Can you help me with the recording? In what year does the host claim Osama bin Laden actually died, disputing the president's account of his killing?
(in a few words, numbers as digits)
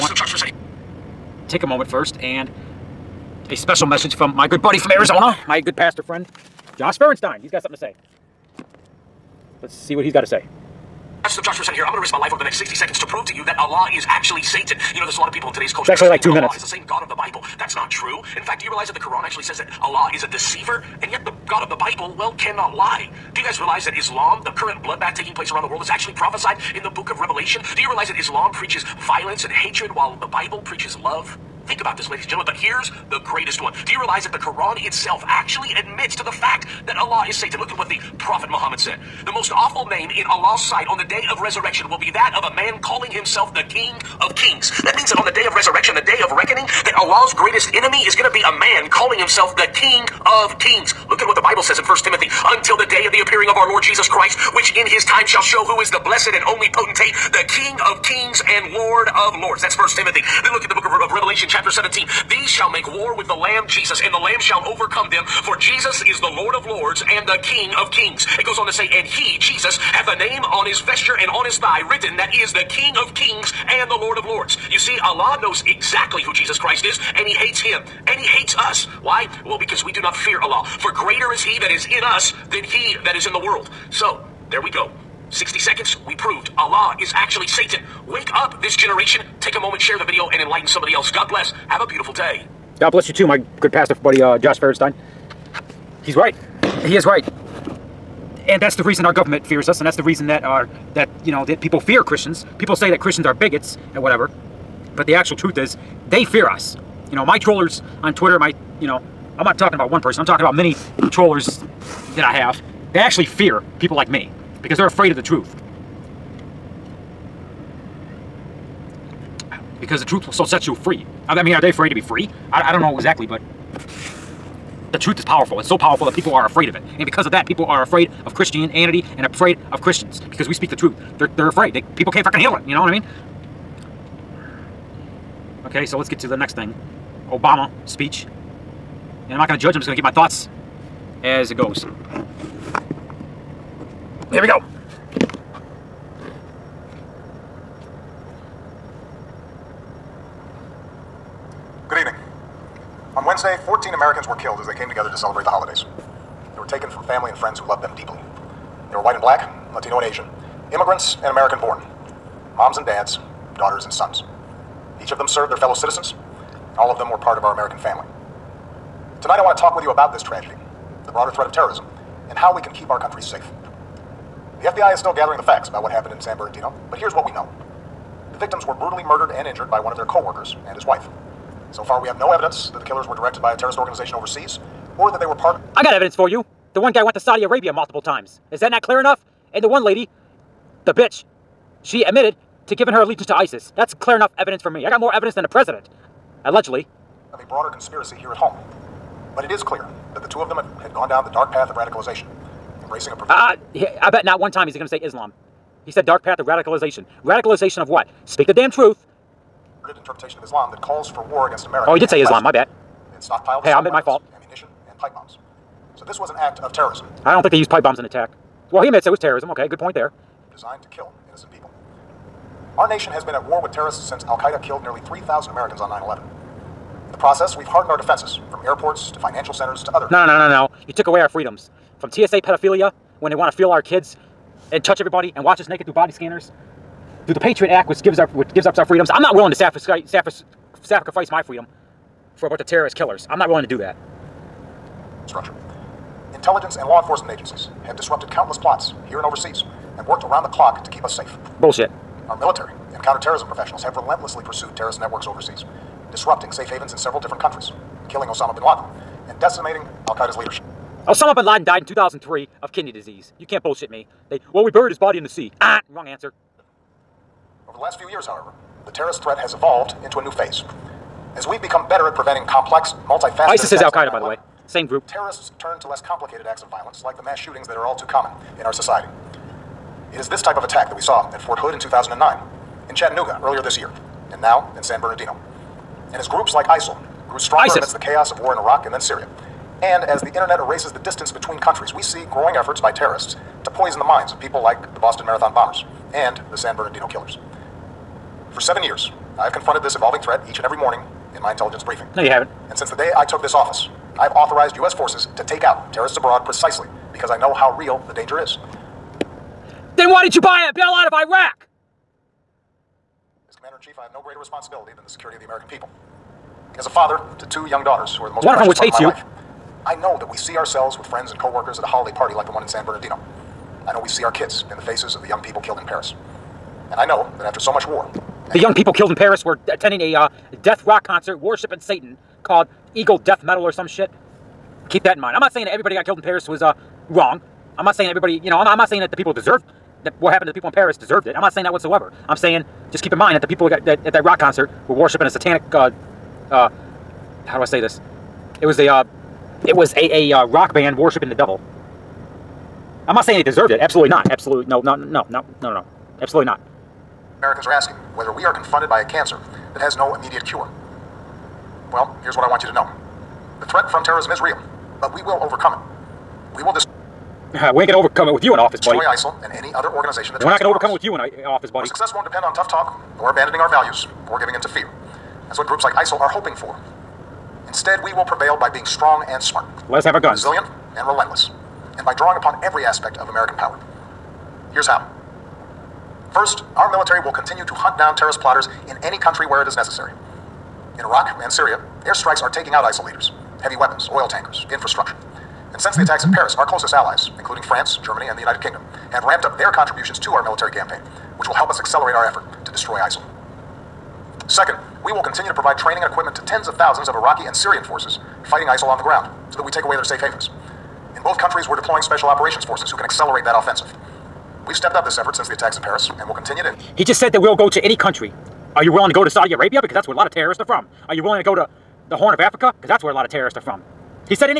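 2003.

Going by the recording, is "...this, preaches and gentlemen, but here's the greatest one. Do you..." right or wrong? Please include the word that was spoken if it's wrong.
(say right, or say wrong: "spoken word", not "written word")
wrong: "ladies", not "preaches".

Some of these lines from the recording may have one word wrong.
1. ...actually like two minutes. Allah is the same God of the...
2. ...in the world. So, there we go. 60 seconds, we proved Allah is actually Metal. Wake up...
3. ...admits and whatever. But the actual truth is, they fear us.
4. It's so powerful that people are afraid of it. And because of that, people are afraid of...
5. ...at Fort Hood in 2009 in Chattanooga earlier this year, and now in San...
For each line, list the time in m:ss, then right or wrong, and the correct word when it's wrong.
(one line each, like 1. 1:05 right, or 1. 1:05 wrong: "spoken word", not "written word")
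1. 0:15 right
2. 1:23 wrong: "Satan", not "Metal"
3. 1:43 wrong: "bigots", not "admits"
4. 2:05 right
5. 4:41 right.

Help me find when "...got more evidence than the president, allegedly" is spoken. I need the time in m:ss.
3:14.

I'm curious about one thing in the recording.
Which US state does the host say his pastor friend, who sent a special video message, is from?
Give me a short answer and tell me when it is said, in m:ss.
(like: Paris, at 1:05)
Arizona, at 0:04.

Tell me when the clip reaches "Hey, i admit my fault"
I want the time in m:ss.
3:33.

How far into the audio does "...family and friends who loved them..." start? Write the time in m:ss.
2:37.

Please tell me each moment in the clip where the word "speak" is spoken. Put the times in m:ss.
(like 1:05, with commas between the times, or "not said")
2:10, 3:28.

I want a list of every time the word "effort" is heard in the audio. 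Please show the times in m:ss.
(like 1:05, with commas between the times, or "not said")
4:52, 6:42, 6:55.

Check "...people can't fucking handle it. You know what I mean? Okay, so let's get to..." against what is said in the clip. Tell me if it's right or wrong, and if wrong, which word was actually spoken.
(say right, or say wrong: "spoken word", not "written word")
right.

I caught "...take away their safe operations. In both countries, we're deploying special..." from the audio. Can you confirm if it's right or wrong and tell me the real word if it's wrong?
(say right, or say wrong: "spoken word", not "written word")
wrong: "havens", not "operations".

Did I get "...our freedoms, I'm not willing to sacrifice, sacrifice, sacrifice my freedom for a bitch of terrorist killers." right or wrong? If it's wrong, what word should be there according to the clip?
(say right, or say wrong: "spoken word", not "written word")
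wrong: "bunch", not "bitch".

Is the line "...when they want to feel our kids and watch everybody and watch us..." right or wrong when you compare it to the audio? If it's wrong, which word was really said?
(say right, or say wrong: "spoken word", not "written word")
wrong: "touch", not "watch".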